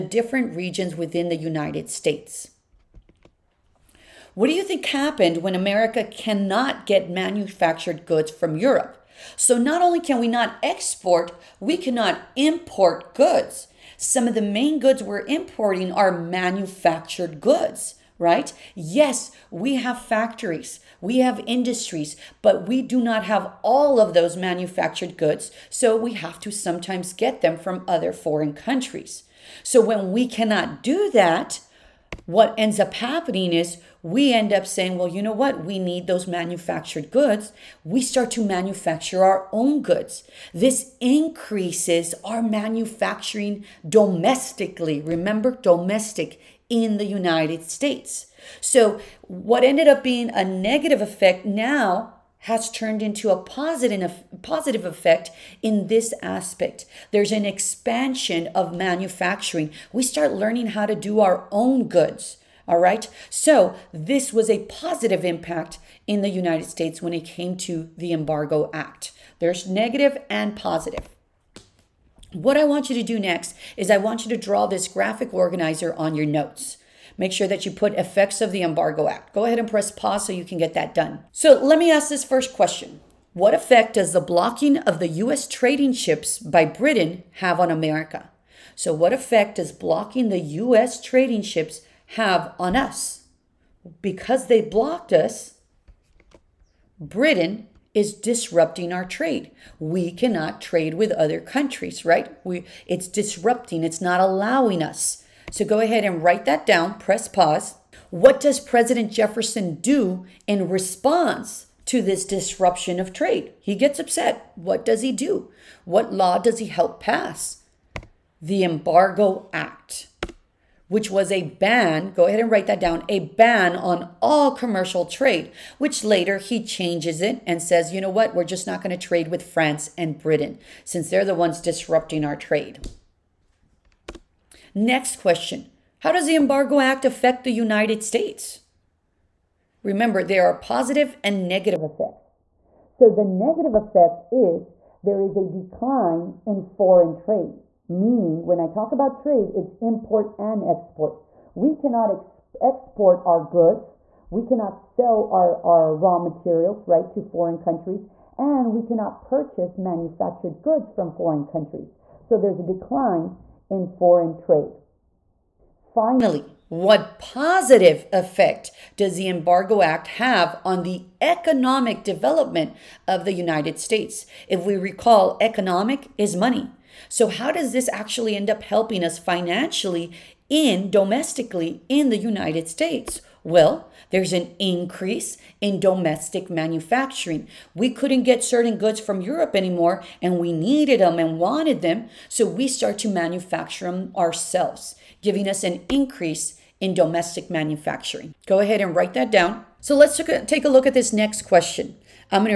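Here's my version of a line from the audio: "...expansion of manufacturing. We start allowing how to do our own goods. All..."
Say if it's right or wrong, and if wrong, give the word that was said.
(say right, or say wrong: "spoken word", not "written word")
wrong: "learning", not "allowing".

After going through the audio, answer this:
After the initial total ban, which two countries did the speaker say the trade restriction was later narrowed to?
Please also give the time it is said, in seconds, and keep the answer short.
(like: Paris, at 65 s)
France and Britain, at 129 s.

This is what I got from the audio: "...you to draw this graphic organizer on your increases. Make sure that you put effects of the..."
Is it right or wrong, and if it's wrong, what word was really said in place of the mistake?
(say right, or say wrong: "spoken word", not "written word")
wrong: "notes", not "increases".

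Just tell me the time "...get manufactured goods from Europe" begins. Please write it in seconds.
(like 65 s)
6 s.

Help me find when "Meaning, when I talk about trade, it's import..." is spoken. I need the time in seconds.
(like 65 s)
147 s.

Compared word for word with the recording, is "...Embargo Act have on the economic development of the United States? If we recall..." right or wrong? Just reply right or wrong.
right.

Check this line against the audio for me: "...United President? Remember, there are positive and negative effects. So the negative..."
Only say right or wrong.
wrong.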